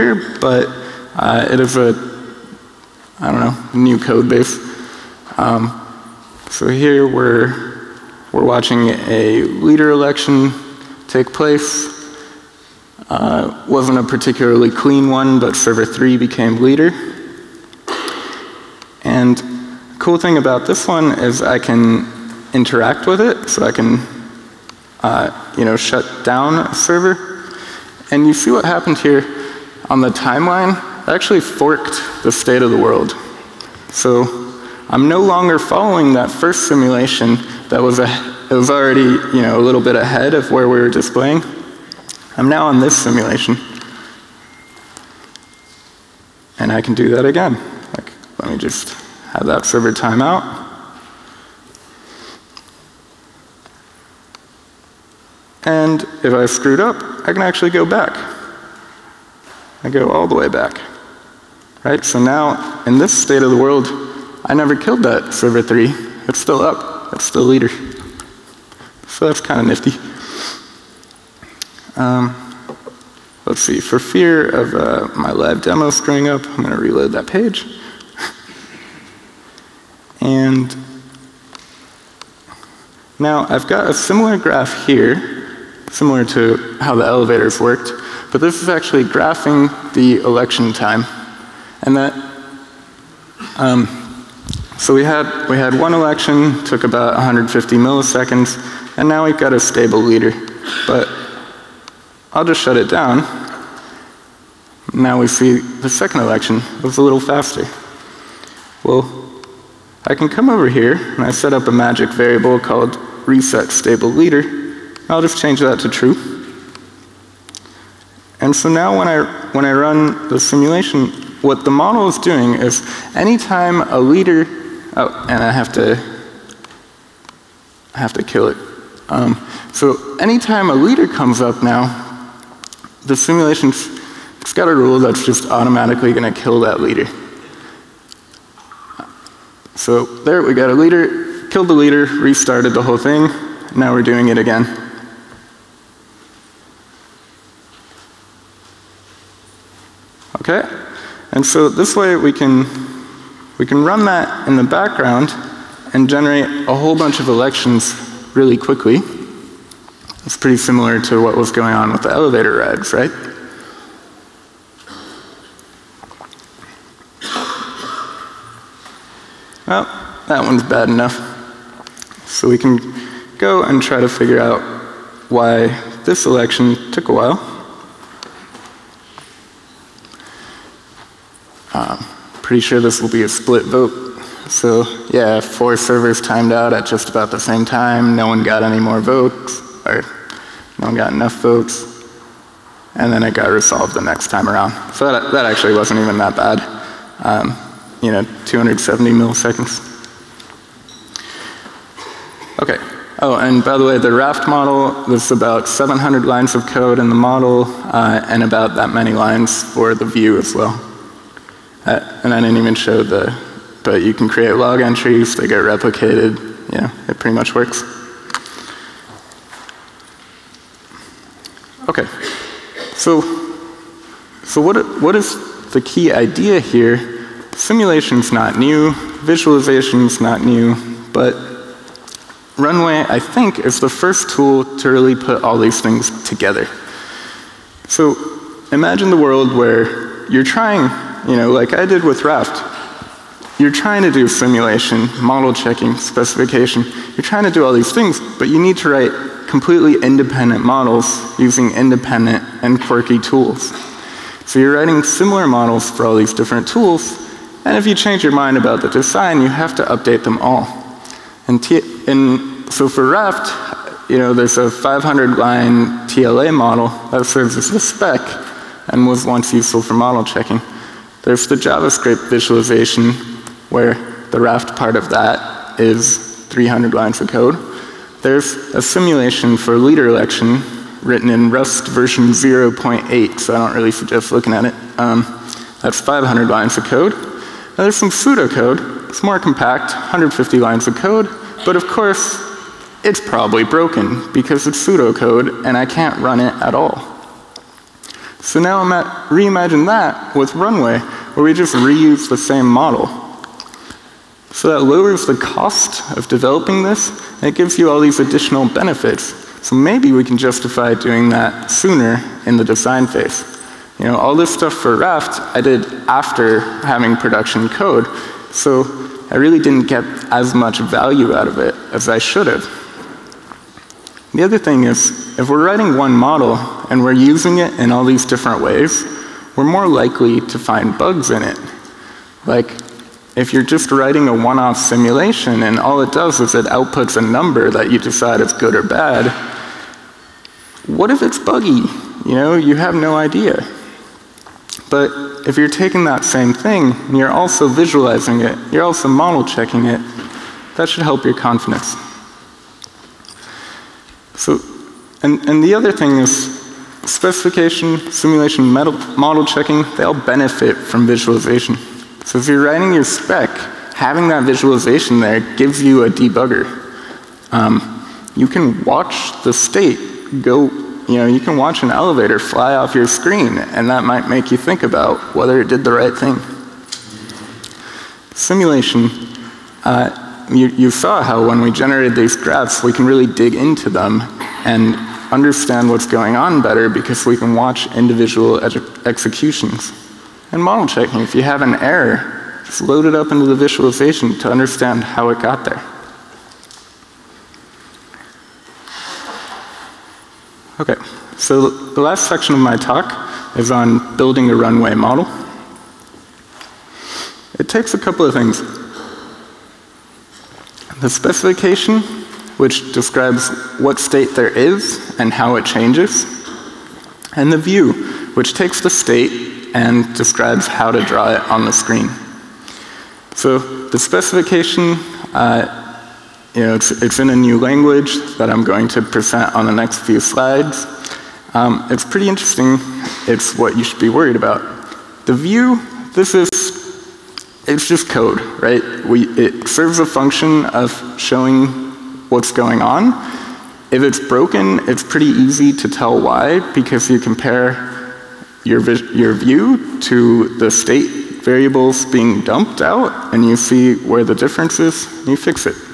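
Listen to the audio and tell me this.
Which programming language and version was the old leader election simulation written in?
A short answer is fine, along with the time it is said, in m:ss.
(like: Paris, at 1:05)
Rust 0.8, at 4:41.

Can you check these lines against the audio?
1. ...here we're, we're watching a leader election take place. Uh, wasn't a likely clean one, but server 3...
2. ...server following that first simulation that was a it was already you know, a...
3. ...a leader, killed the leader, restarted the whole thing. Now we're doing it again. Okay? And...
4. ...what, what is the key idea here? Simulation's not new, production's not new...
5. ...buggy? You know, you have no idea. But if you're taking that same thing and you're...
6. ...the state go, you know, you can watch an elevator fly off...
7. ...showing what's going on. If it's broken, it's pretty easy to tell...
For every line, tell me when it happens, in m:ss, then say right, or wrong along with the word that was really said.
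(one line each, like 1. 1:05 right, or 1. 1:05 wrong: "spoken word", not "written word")
1. 0:06 wrong: "particularly", not "likely"
2. 0:35 wrong: "longer", not "server"
3. 2:20 right
4. 3:44 wrong: "visualization", not "production"
5. 5:41 right
6. 6:09 right
7. 7:21 right.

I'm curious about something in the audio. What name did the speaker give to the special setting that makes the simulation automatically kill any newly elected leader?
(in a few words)
reset stable leader.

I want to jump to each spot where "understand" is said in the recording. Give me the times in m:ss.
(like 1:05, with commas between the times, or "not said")
6:25, 6:34.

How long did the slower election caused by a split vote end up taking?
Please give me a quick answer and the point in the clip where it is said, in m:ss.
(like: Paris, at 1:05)
270 milliseconds, at 3:18.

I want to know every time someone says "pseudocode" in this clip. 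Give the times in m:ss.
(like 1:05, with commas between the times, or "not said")
4:48, 4:54.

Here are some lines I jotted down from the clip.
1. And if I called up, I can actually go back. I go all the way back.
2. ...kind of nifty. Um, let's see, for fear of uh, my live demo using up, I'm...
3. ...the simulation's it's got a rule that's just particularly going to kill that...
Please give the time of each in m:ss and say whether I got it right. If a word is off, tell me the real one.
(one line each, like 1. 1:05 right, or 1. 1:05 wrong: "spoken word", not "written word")
1. 0:55 wrong: "screwed", not "called"
2. 1:09 wrong: "screwing", not "using"
3. 2:13 wrong: "automatically", not "particularly".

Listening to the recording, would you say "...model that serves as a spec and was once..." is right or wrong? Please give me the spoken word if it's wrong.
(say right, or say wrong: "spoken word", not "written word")
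right.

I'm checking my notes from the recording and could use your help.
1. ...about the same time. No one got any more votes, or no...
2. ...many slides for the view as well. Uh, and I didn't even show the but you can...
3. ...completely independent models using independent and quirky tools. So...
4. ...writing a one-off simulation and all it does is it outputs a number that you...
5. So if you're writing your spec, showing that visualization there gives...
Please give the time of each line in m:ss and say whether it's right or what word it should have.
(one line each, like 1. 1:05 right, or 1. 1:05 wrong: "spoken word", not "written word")
1. 3:07 right
2. 3:28 wrong: "lines", not "slides"
3. 4:09 right
4. 5:33 right
5. 6:02 wrong: "having", not "showing".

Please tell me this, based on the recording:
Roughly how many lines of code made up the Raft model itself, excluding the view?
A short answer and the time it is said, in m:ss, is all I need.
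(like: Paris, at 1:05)
700, at 3:25.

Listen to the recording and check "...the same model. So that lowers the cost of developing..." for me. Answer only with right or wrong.
right.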